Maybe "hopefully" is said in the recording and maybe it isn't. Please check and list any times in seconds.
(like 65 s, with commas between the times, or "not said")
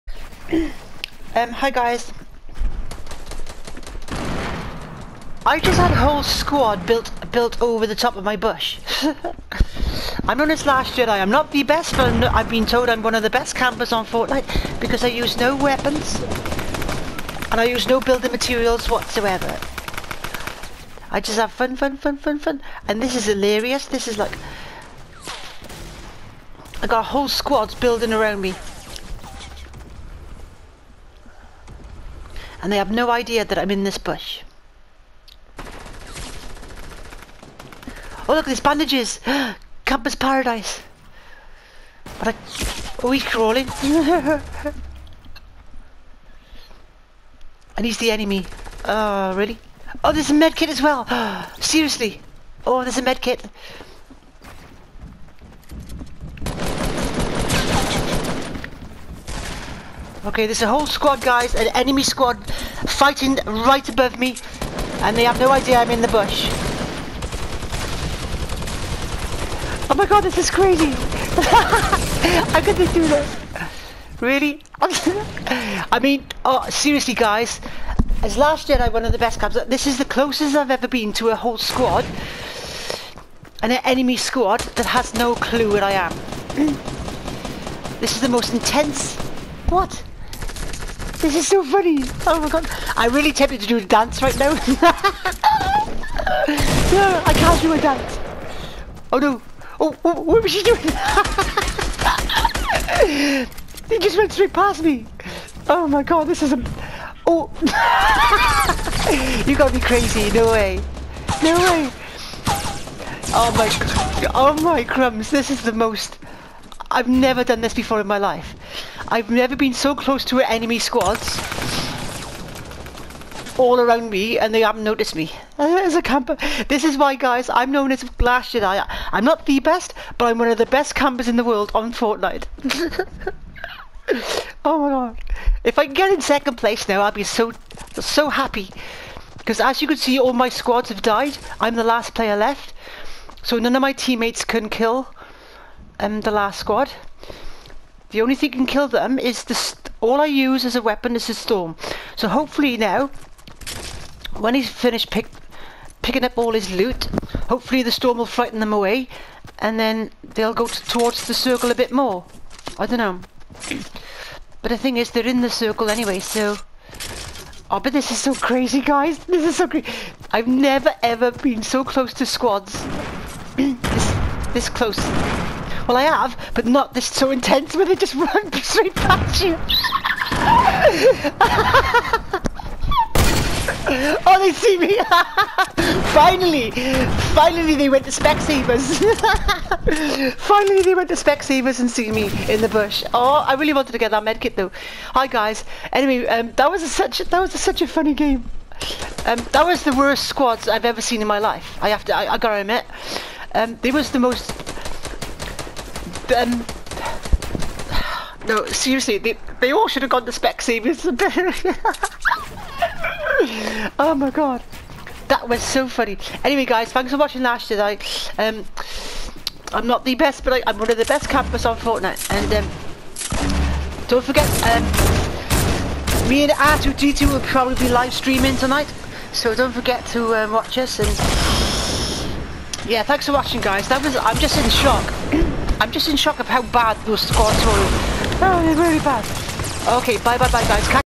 152 s, 157 s.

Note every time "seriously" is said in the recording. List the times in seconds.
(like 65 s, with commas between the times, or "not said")
51 s, 76 s, 208 s.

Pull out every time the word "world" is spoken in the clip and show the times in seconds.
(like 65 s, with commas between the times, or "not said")
131 s.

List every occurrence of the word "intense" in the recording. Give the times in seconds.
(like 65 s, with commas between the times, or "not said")
88 s, 177 s.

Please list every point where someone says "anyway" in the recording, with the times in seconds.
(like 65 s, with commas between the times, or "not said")
165 s, 195 s, 216 s.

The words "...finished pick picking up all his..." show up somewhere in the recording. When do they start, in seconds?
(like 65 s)
154 s.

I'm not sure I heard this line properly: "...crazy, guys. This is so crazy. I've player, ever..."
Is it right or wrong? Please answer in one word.
wrong.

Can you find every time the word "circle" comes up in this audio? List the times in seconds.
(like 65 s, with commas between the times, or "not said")
161 s, 165 s.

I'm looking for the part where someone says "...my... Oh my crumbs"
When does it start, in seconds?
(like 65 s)
113 s.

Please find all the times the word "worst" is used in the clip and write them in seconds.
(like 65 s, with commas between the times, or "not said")
199 s.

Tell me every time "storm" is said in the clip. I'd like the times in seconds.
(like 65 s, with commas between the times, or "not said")
151 s, 157 s.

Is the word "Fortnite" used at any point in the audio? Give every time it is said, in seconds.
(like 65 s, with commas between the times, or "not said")
14 s, 131 s, 221 s.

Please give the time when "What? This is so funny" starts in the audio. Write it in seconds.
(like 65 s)
89 s.